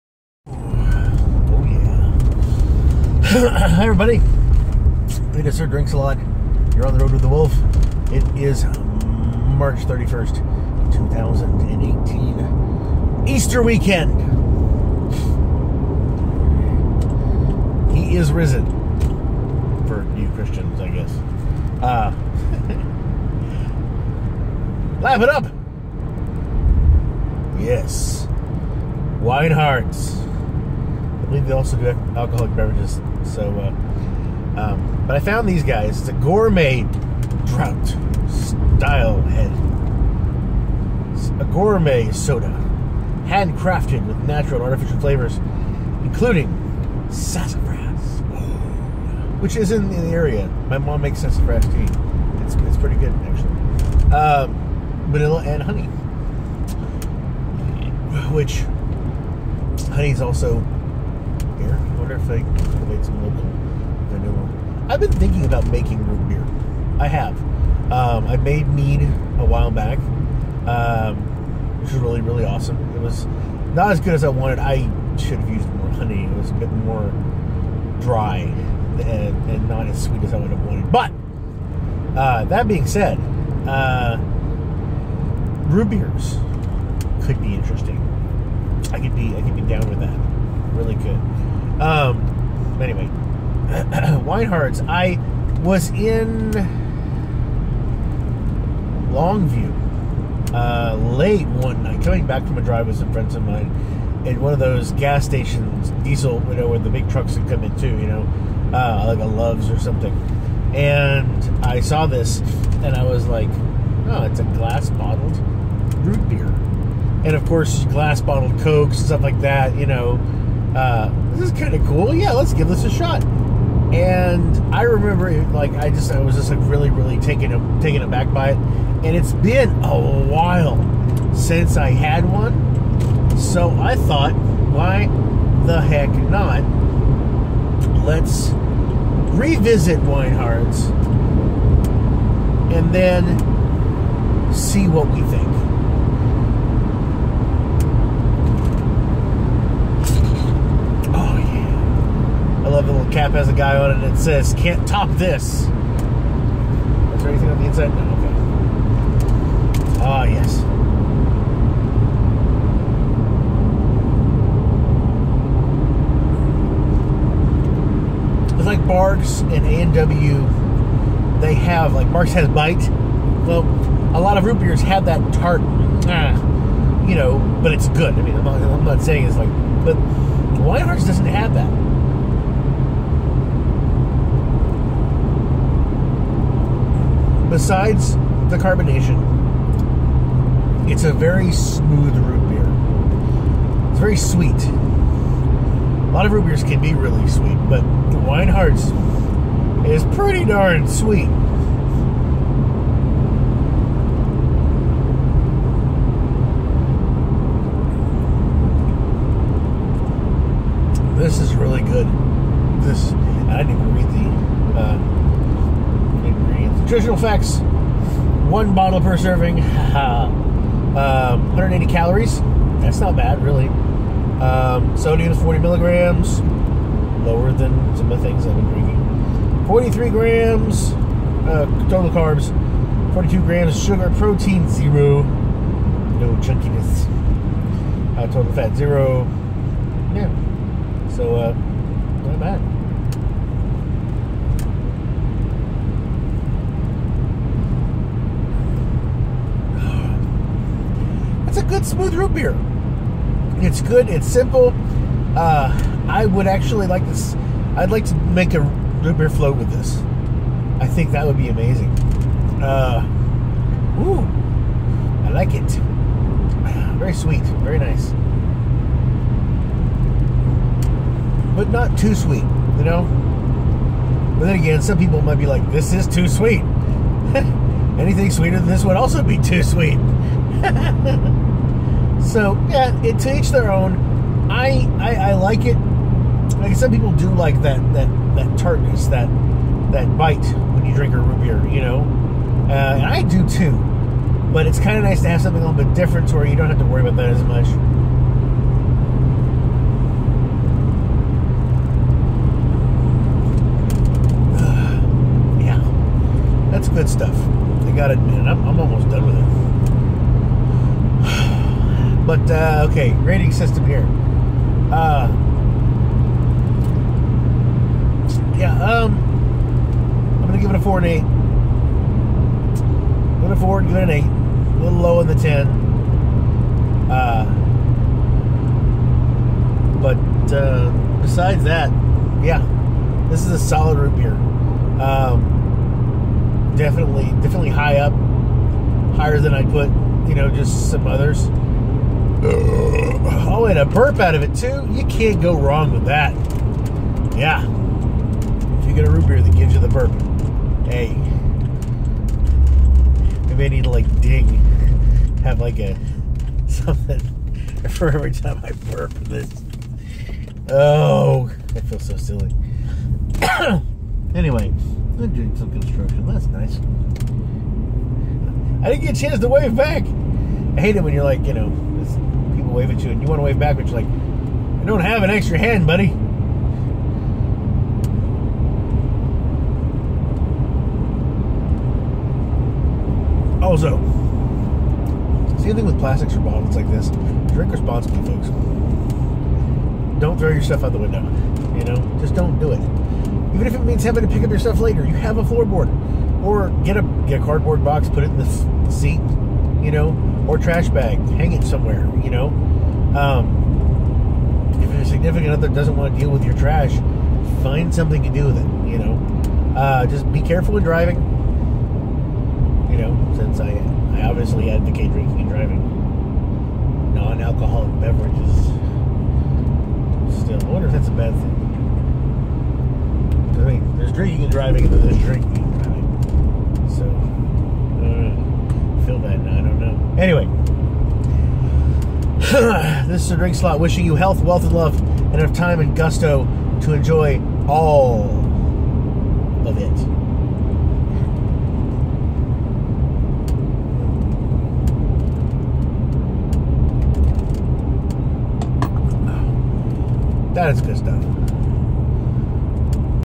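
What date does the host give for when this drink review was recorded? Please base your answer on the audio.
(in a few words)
March 31st, 2018.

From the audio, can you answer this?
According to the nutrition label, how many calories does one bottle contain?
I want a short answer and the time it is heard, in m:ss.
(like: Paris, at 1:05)
180, at 3:41.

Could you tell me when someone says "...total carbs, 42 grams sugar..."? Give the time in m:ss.
3:51.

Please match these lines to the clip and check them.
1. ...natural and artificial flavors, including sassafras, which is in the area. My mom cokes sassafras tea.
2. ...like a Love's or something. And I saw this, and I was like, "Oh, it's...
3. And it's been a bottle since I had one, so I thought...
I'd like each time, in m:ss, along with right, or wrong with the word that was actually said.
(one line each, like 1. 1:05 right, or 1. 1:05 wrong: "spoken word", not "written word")
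1. 0:44 wrong: "makes", not "cokes"
2. 1:49 right
3. 2:08 wrong: "while", not "bottle".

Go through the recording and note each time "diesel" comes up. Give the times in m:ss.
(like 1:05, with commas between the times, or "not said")
1:46.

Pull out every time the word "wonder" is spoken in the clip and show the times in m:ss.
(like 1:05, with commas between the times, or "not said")
1:02, 7:00.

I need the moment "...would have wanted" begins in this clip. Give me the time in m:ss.
1:20.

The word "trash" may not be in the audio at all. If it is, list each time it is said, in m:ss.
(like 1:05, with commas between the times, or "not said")
6:40, 6:46.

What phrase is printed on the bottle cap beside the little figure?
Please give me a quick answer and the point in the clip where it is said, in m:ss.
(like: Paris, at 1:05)
Can't top this, at 2:34.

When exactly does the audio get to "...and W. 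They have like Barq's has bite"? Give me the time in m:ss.
2:49.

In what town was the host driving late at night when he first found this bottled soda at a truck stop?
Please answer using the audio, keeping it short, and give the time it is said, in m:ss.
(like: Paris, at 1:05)
Longview, at 1:39.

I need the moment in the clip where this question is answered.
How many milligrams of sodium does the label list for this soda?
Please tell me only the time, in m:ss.
3:45.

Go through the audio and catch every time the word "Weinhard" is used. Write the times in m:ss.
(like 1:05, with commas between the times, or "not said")
0:29, 1:34, 2:19, 3:00.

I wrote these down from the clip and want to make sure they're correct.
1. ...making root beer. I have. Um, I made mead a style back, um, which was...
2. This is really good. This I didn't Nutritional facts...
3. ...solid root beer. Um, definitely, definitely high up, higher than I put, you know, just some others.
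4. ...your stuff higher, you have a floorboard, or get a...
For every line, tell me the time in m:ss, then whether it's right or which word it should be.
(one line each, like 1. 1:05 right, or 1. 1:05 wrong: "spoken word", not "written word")
1. 1:05 wrong: "while", not "style"
2. 3:31 right
3. 5:33 right
4. 6:34 wrong: "later", not "higher".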